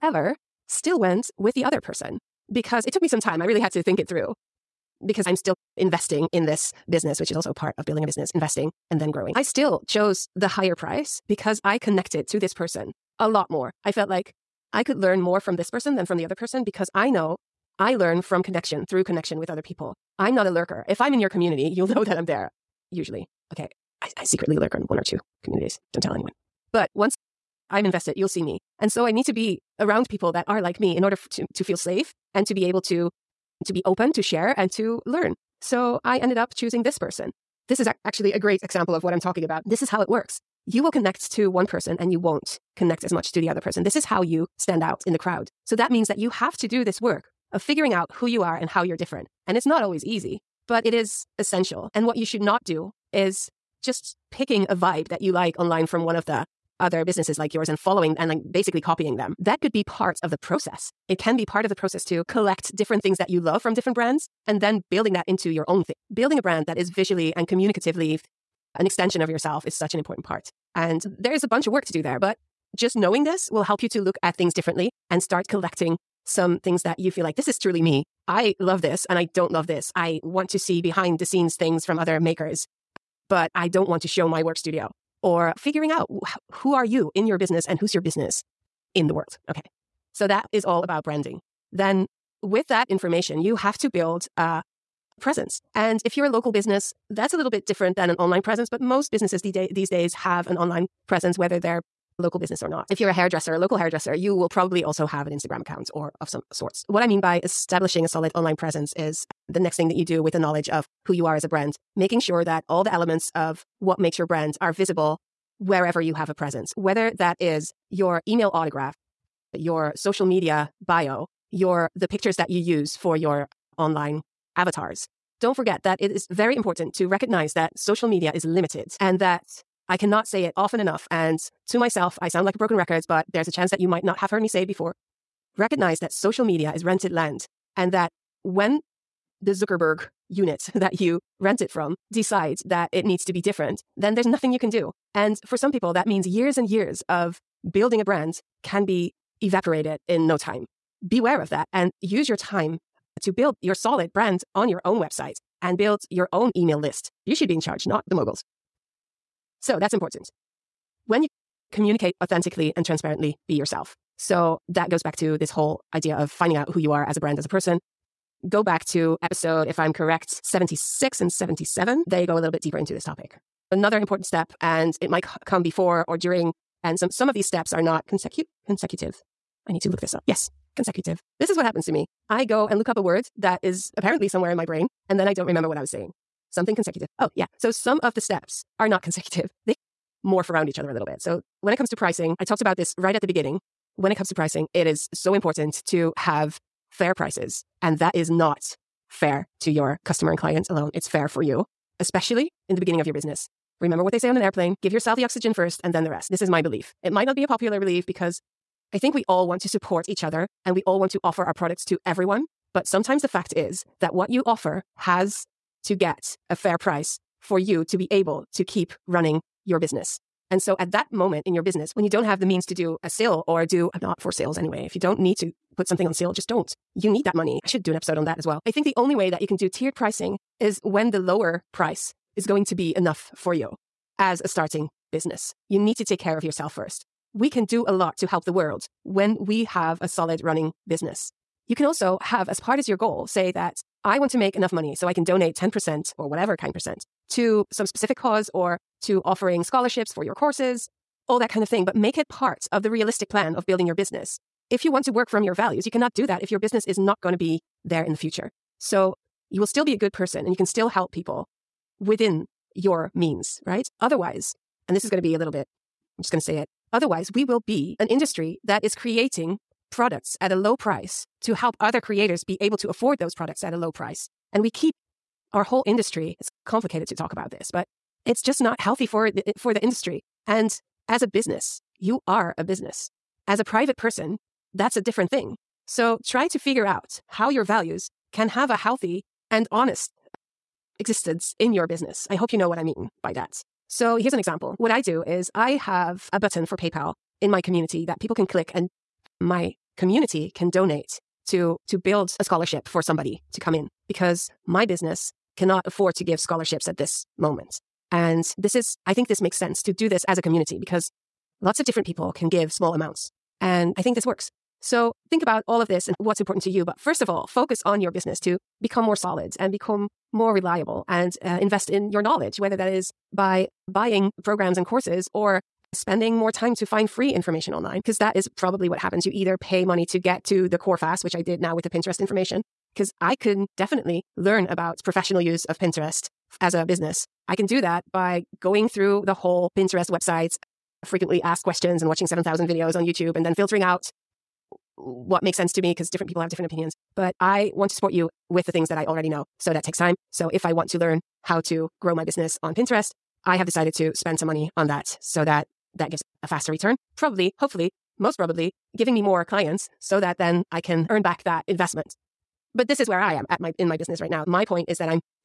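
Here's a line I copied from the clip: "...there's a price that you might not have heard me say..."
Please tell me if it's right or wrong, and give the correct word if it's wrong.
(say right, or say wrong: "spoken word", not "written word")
wrong: "chance", not "price".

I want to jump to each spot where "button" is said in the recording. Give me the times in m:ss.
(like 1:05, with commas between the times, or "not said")
4:56.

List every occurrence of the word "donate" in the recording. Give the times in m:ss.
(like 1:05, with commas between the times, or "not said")
4:05, 5:00.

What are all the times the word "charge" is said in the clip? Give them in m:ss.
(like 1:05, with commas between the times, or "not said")
2:37.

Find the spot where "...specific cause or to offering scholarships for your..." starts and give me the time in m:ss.
4:07.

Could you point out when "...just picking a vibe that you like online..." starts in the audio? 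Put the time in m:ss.
0:53.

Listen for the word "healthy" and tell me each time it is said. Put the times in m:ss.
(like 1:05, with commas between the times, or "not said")
4:38, 4:48.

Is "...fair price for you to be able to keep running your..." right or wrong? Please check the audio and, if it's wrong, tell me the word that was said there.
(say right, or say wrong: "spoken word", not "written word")
right.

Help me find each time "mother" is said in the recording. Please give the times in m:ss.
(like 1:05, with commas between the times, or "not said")
not said.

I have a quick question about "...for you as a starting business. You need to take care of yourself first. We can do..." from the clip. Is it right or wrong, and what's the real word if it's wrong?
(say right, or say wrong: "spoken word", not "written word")
right.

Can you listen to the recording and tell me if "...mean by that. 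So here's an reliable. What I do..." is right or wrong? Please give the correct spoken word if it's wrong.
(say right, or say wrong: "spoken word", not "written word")
wrong: "example", not "reliable".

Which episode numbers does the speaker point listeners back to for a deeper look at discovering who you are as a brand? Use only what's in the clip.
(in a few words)
76 and 77.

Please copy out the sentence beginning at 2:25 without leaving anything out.
And for some people, that means years and years of building a brand can be evaporated in no time.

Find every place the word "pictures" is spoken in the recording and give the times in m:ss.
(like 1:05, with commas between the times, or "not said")
2:02.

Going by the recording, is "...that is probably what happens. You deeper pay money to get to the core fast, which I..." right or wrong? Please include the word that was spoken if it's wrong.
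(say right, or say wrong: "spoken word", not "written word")
wrong: "either", not "deeper".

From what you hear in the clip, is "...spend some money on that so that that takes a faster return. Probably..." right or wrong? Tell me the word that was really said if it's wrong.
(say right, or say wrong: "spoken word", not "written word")
wrong: "gives", not "takes".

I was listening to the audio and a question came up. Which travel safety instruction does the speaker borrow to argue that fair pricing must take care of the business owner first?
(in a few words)
oxygen first.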